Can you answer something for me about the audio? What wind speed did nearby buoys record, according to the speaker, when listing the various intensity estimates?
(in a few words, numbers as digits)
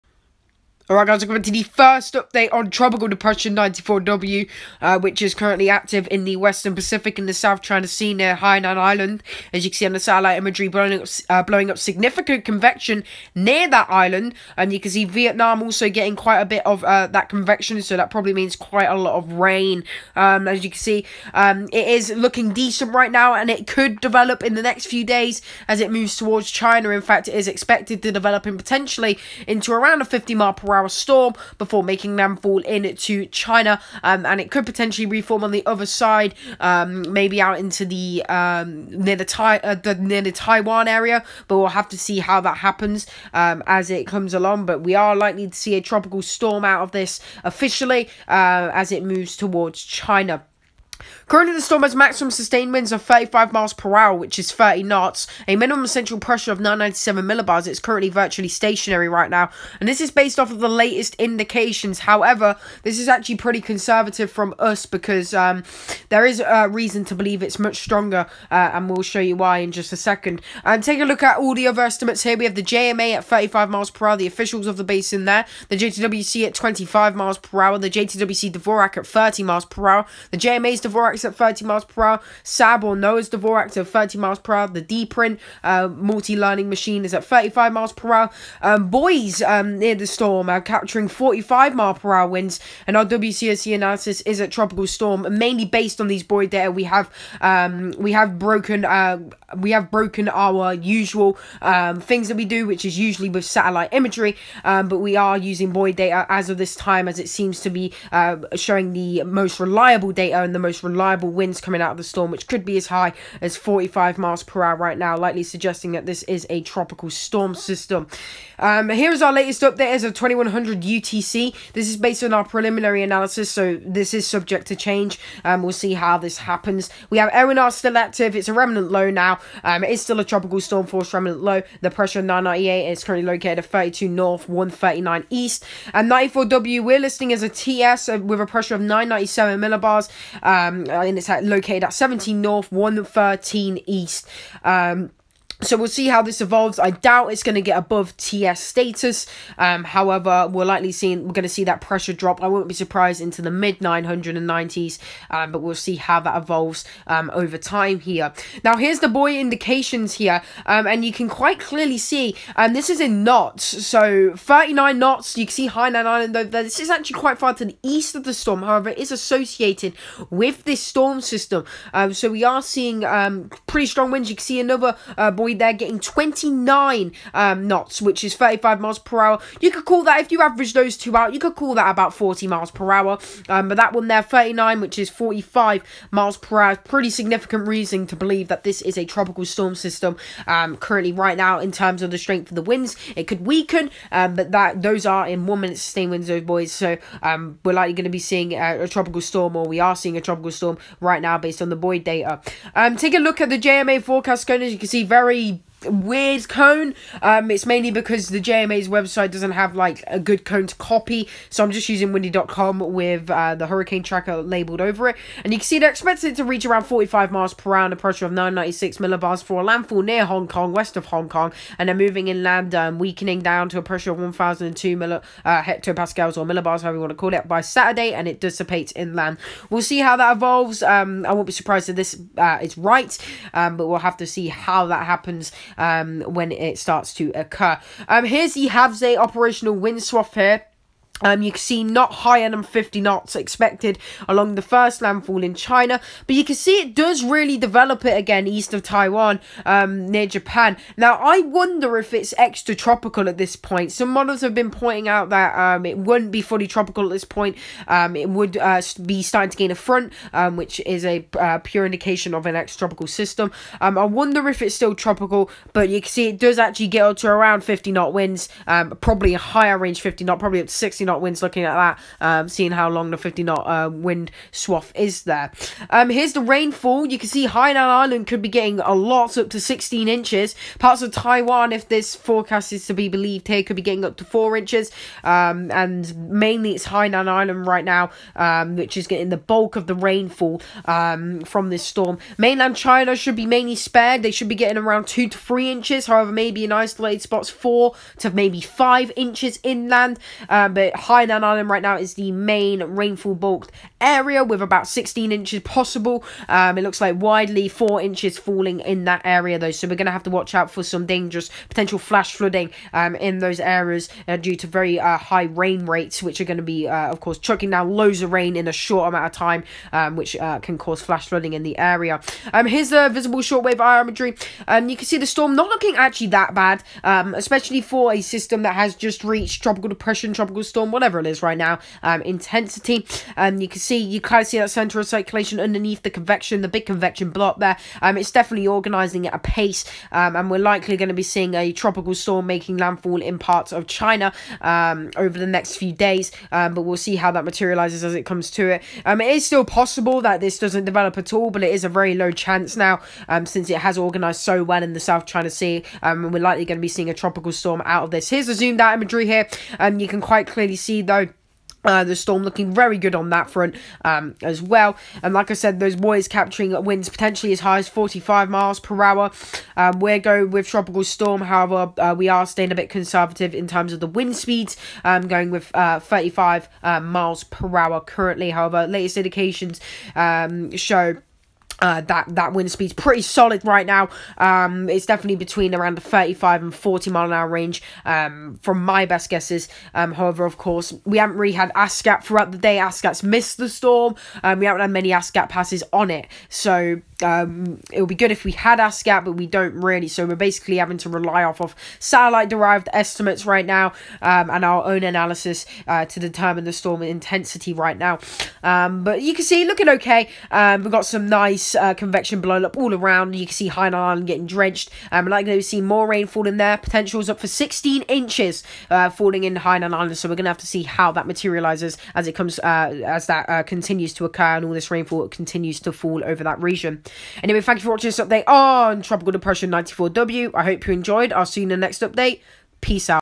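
45 mph.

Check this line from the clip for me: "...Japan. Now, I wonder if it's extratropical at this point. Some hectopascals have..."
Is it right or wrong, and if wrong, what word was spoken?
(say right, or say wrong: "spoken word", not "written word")
wrong: "models", not "hectopascals".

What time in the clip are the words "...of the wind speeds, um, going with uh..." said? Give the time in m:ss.
6:13.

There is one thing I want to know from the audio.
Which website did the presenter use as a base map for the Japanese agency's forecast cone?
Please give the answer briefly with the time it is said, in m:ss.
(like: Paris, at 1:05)
windy.com, at 3:32.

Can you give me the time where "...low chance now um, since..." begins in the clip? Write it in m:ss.
5:52.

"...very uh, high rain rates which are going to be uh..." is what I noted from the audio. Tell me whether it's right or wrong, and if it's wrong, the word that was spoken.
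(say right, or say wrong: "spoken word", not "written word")
right.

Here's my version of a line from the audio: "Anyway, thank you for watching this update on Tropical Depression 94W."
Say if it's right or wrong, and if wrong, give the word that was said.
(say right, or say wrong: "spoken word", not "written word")
right.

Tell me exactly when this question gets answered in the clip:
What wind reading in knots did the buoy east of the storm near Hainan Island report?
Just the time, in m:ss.
2:44.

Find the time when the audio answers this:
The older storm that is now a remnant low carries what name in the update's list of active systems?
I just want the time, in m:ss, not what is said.
2:07.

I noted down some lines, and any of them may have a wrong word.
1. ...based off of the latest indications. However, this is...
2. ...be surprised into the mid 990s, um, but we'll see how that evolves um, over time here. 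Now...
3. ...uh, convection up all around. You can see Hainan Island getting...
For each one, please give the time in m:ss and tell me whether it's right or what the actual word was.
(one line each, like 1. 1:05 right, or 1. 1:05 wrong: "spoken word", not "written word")
1. 1:00 right
2. 2:32 right
3. 6:51 right.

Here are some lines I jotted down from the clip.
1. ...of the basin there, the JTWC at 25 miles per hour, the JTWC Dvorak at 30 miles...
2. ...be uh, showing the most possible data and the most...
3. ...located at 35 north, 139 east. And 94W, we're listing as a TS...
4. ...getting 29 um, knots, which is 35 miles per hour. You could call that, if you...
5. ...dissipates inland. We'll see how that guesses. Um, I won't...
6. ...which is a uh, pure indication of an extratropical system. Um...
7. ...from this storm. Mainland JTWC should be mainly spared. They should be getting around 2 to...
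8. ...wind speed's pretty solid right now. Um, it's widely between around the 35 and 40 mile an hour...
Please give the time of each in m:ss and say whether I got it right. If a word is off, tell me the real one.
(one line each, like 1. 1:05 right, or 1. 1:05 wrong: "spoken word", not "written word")
1. 1:14 right
2. 1:47 wrong: "reliable", not "possible"
3. 2:13 wrong: "32", not "35"
4. 2:55 right
5. 3:48 wrong: "evolves", not "guesses"
6. 4:20 right
7. 4:51 wrong: "China", not "JTWC"
8. 6:22 wrong: "definitely", not "widely".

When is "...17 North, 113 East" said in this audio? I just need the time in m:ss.
2:21.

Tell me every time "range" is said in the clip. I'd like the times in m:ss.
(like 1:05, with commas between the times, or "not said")
4:29, 6:27.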